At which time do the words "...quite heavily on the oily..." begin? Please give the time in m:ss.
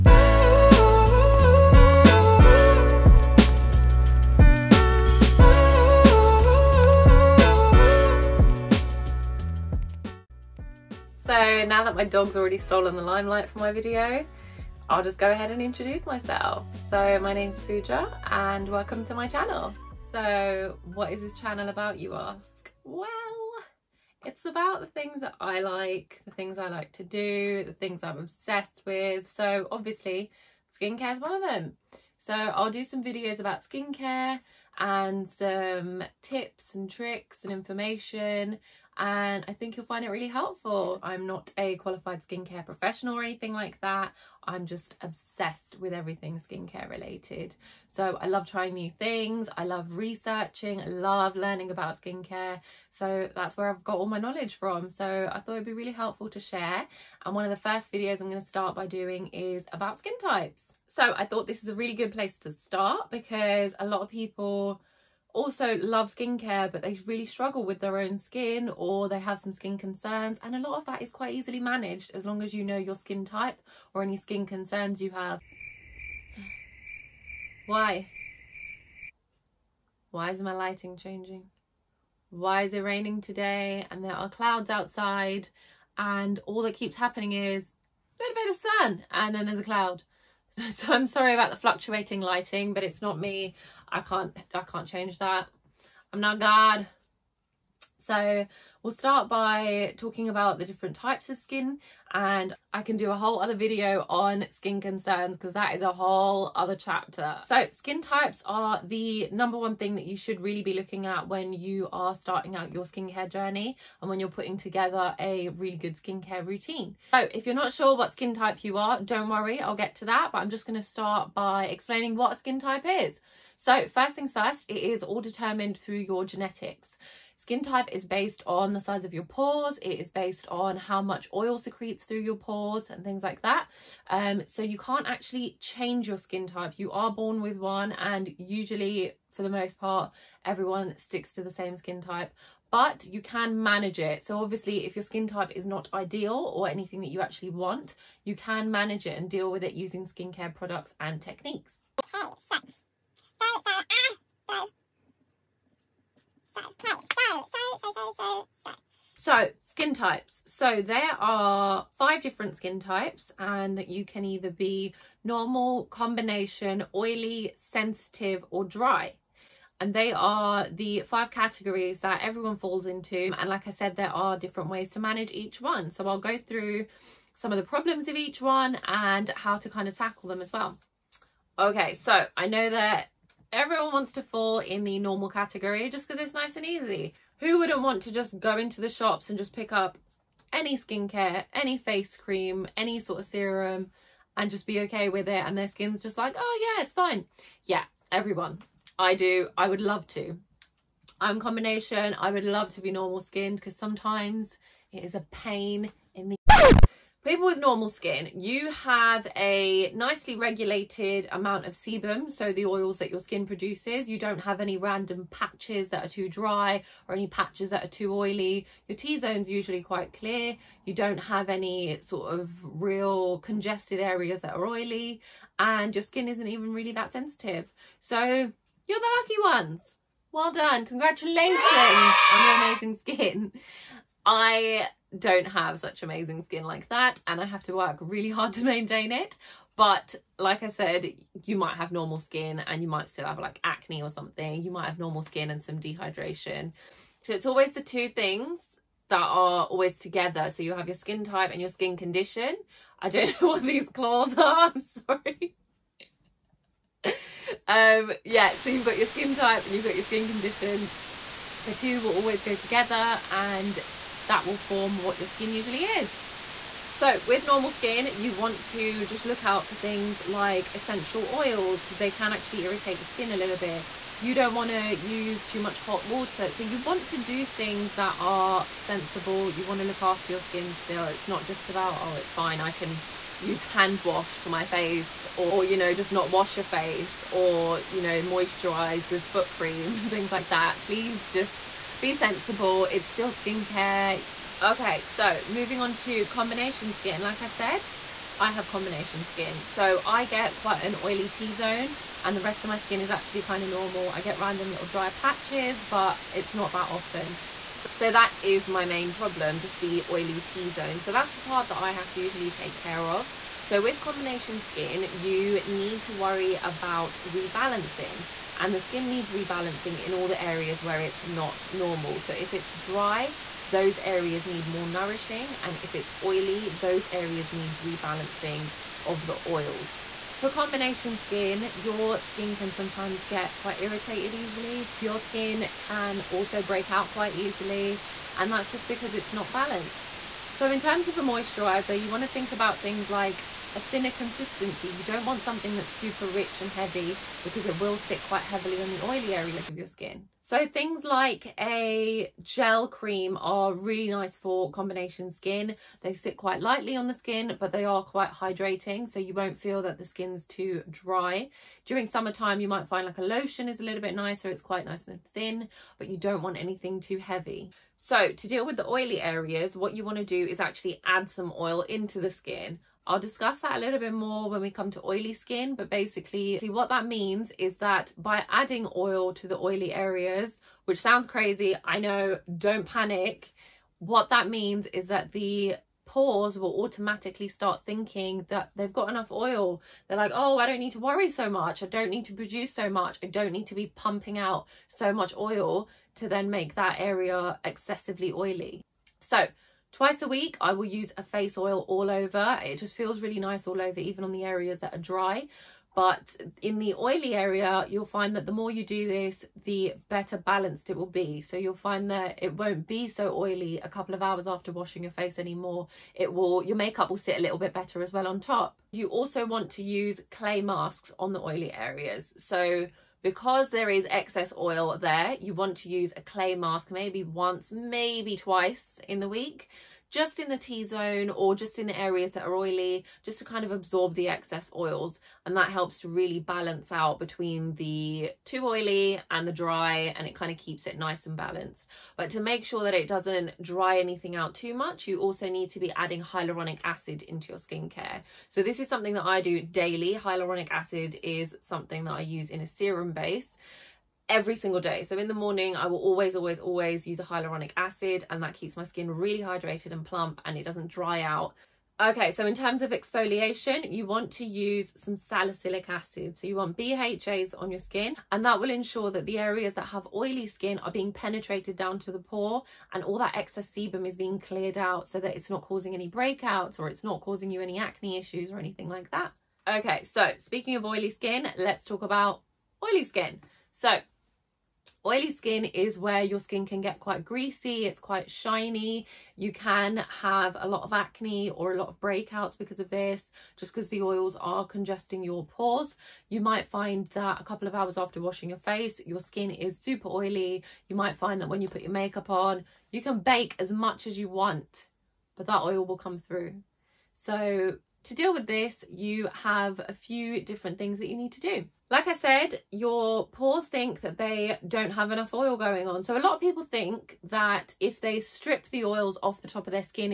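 5:48.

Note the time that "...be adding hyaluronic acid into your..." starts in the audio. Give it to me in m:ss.
7:25.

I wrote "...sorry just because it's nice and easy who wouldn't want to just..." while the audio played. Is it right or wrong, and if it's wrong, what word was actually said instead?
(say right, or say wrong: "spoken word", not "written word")
wrong: "category", not "sorry".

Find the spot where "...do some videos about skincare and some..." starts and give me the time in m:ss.
0:32.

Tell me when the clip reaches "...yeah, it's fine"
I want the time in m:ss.
3:16.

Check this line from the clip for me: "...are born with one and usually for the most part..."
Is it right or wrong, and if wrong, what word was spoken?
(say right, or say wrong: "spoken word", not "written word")
right.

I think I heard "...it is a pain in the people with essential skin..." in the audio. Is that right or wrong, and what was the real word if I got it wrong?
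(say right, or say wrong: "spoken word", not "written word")
wrong: "normal", not "essential".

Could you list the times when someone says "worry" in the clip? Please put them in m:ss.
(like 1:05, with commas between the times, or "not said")
1:59, 5:16, 6:30.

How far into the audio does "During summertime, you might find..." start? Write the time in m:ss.
6:01.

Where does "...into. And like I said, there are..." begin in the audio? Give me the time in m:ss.
2:52.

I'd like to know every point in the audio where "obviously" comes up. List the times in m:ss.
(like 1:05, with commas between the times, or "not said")
0:29, 2:24.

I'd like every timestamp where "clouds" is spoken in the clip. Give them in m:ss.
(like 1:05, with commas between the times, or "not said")
1:24, 1:29.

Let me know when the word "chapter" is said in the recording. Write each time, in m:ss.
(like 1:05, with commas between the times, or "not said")
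1:46.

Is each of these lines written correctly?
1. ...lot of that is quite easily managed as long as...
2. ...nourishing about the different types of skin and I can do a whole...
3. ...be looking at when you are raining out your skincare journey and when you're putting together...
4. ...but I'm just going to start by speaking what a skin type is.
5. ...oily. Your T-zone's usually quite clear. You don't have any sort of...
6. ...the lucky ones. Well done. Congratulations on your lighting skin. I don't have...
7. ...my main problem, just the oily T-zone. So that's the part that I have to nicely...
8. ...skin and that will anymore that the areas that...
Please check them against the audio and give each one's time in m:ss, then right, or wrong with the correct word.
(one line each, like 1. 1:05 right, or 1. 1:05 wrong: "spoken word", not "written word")
1. 1:10 right
2. 1:39 wrong: "talking", not "nourishing"
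3. 1:50 wrong: "starting", not "raining"
4. 2:00 wrong: "explaining", not "speaking"
5. 3:38 right
6. 3:48 wrong: "amazing", not "lighting"
7. 5:08 wrong: "usually", not "nicely"
8. 7:47 wrong: "ensure", not "anymore".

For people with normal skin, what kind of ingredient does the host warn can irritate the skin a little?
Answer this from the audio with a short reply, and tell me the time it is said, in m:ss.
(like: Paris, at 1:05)
Essential oils, at 4:30.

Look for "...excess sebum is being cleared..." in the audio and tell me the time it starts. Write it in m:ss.
7:53.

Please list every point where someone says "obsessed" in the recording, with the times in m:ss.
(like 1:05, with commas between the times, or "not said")
0:28, 0:45.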